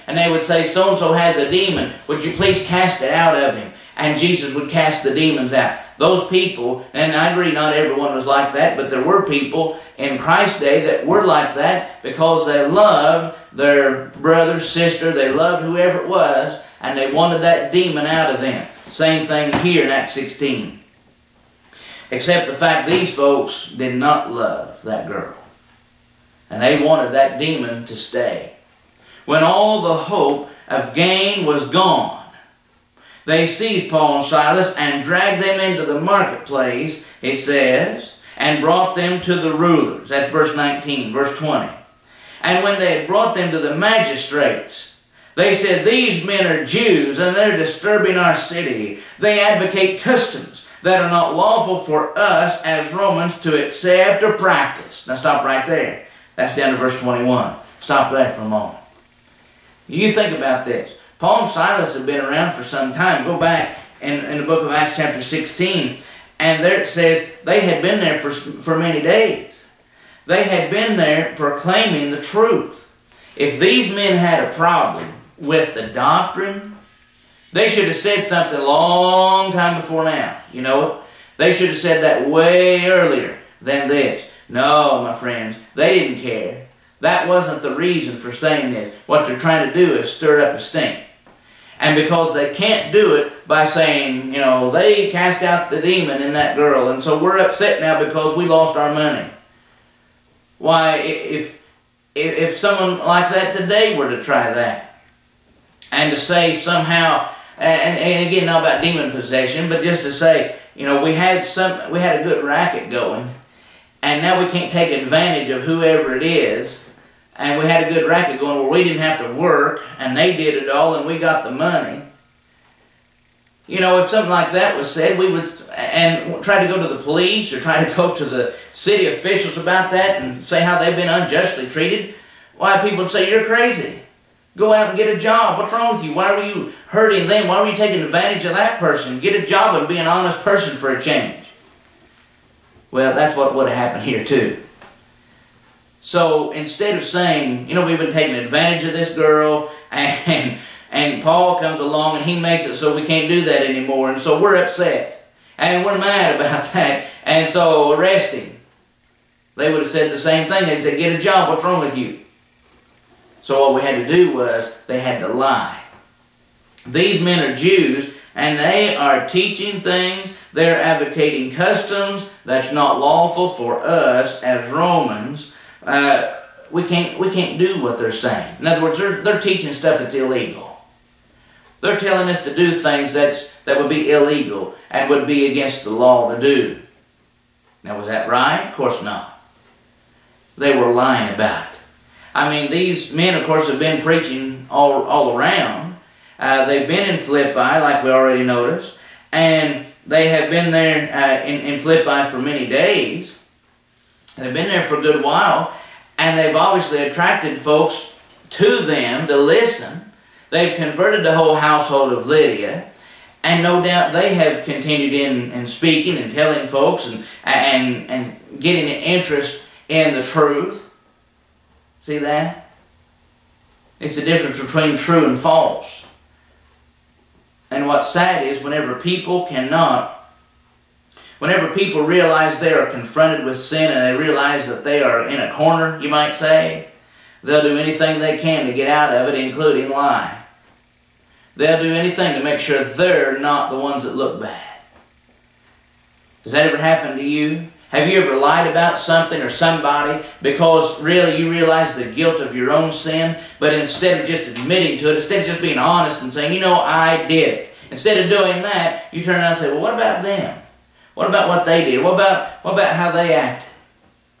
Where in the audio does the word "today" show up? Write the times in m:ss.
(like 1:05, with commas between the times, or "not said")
1:43.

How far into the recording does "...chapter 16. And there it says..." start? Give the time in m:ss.
1:04.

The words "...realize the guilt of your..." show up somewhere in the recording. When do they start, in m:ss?
4:11.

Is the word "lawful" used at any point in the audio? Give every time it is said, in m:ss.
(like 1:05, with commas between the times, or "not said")
0:51, 2:52.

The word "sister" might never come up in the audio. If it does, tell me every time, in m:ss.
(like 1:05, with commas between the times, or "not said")
0:14.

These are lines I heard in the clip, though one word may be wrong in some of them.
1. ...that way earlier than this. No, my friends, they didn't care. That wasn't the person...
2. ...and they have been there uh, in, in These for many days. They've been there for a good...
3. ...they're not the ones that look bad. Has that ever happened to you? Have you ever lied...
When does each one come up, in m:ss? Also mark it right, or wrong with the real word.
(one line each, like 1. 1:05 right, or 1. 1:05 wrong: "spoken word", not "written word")
1. 1:22 wrong: "reason", not "person"
2. 3:19 wrong: "Philippi", not "These"
3. 4:02 right.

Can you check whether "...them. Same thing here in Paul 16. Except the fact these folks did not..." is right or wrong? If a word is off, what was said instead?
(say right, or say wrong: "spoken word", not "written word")
wrong: "Acts", not "Paul".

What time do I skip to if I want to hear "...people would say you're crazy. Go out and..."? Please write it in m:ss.
2:12.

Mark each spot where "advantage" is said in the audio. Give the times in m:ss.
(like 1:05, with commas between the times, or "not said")
1:55, 2:18, 2:28.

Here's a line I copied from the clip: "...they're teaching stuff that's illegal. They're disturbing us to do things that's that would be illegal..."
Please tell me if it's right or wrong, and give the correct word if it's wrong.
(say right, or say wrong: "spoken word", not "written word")
wrong: "telling", not "disturbing".